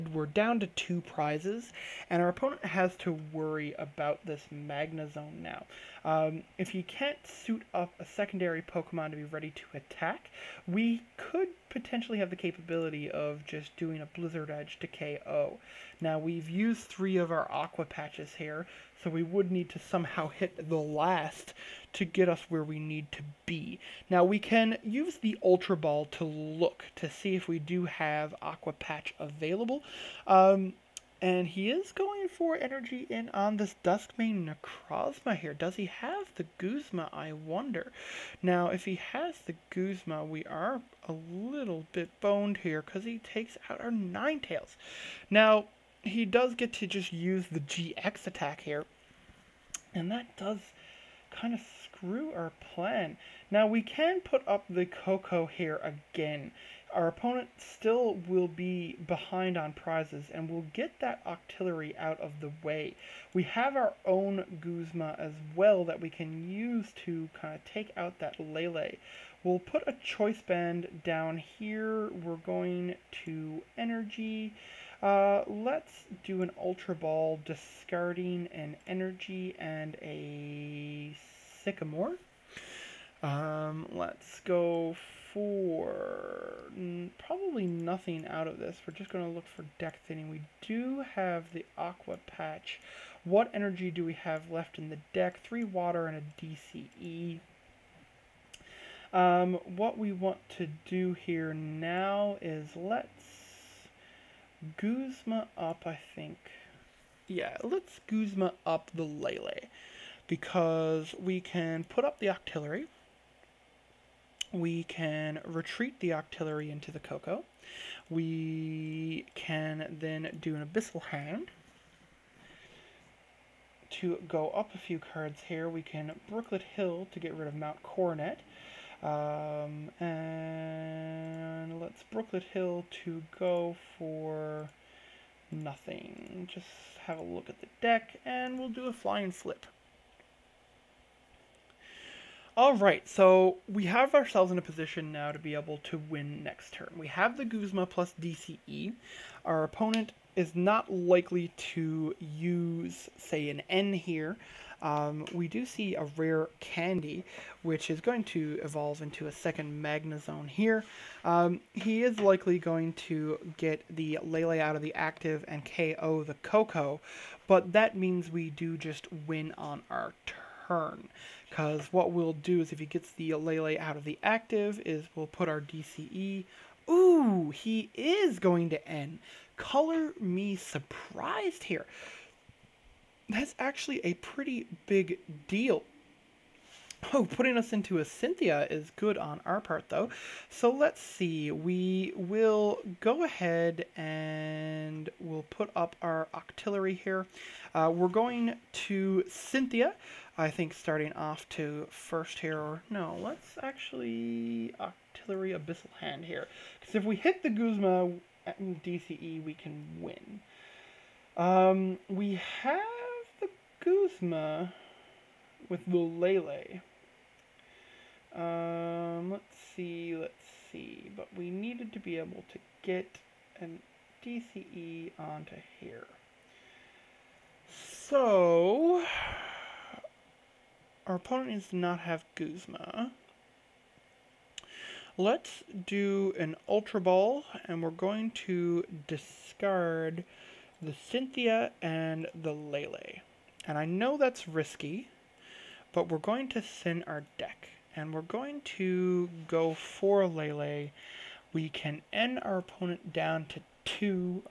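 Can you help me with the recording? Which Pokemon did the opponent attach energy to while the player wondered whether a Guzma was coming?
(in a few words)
Duskmane Necrozma.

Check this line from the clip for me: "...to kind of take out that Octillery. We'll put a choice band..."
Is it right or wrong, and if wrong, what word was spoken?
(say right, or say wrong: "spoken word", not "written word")
wrong: "Lele", not "Octillery".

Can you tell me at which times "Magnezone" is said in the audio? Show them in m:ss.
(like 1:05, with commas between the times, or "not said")
0:04, 2:39.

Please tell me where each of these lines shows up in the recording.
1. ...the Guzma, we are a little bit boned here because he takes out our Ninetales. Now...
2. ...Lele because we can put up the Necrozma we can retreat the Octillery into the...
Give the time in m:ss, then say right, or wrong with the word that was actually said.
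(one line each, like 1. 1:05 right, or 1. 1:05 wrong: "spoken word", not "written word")
1. 0:39 right
2. 1:49 wrong: "Octillery", not "Necrozma".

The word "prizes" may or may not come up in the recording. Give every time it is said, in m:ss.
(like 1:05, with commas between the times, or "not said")
0:01, 0:59.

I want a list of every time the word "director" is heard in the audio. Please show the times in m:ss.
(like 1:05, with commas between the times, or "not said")
not said.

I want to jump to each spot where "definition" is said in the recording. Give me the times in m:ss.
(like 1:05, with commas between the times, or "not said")
not said.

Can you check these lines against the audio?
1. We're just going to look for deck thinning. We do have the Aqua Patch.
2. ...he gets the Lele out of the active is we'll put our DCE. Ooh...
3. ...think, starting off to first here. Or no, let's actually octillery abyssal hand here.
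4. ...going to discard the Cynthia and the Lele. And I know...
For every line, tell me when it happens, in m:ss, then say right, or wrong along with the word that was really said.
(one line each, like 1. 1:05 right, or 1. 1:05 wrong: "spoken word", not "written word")
1. 1:28 right
2. 2:52 right
3. 3:20 right
4. 3:57 right.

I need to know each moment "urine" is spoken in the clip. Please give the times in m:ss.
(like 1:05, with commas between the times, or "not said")
not said.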